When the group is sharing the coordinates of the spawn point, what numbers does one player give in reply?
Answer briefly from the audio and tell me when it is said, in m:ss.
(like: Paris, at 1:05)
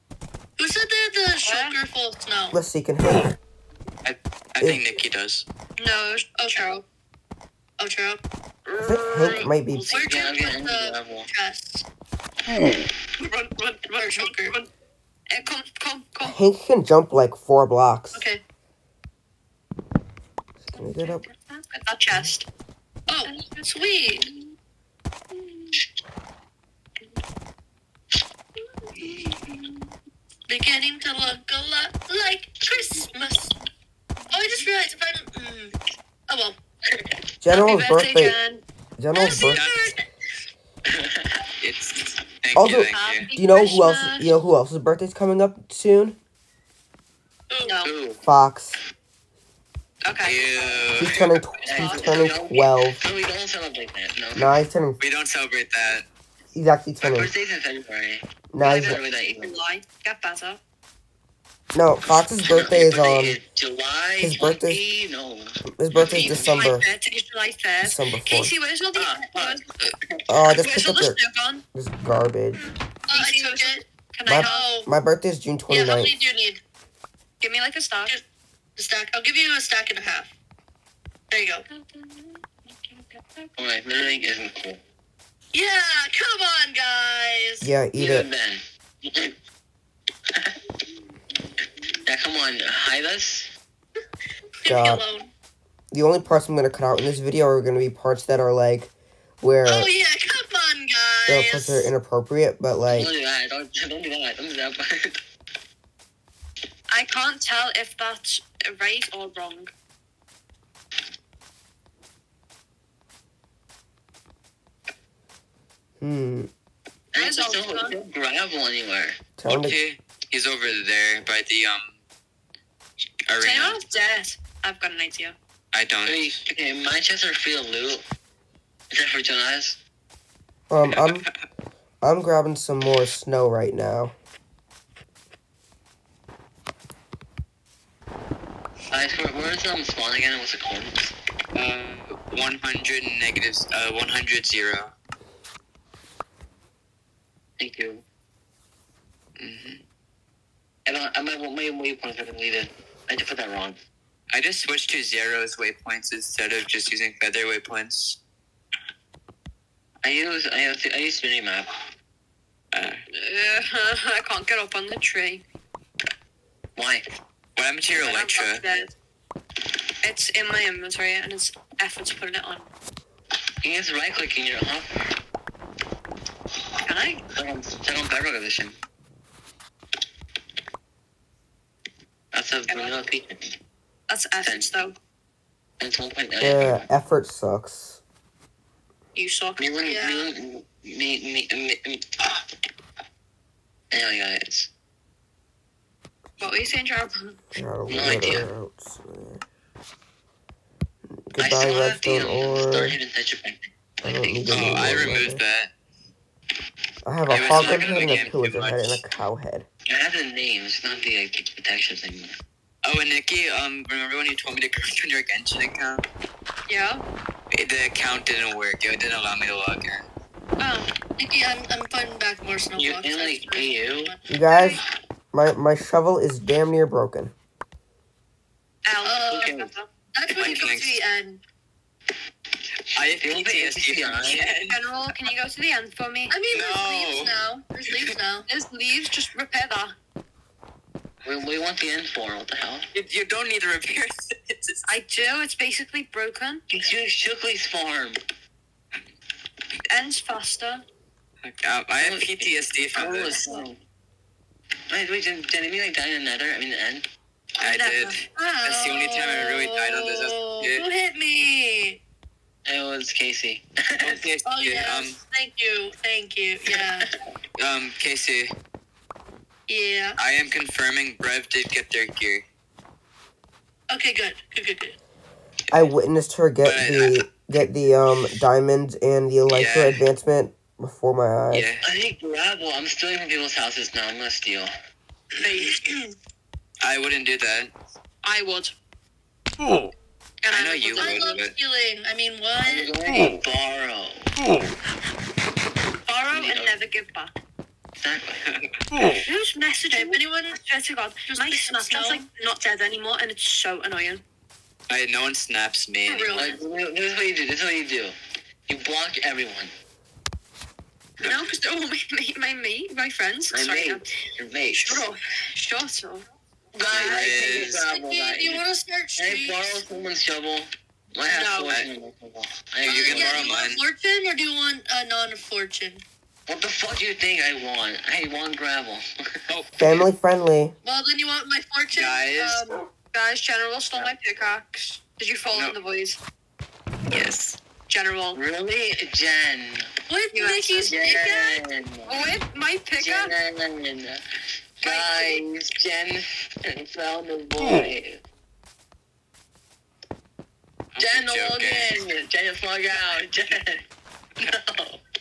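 100 0, at 2:23.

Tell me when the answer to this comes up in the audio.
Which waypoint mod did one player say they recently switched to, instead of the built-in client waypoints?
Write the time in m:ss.
2:34.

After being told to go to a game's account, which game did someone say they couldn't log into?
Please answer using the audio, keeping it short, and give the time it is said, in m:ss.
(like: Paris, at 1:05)
Genshin, at 3:35.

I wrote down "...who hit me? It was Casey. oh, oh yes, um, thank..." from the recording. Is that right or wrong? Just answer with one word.
right.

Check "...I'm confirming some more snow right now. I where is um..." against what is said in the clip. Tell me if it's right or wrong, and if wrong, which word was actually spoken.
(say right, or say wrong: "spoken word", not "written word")
wrong: "grabbing", not "confirming".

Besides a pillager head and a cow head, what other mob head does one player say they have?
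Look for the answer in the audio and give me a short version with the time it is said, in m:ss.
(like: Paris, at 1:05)
Hog head, at 3:27.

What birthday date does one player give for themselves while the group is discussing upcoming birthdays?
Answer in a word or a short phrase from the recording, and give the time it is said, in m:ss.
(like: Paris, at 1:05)
June 29th, at 1:15.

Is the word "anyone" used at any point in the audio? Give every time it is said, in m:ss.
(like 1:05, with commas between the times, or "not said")
2:03, 5:00.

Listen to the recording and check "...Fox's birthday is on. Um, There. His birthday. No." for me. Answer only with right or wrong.
wrong.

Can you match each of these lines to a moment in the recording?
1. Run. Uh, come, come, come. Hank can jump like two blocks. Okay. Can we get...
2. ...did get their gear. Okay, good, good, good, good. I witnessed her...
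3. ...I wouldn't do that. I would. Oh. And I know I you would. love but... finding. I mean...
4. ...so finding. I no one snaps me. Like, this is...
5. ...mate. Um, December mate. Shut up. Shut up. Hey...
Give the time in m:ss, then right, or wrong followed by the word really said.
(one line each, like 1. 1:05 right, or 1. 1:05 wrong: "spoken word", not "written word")
1. 0:14 wrong: "four", not "two"
2. 4:31 right
3. 4:46 wrong: "stealing", not "finding"
4. 5:03 wrong: "annoying", not "finding"
5. 5:13 wrong: "Your", not "December".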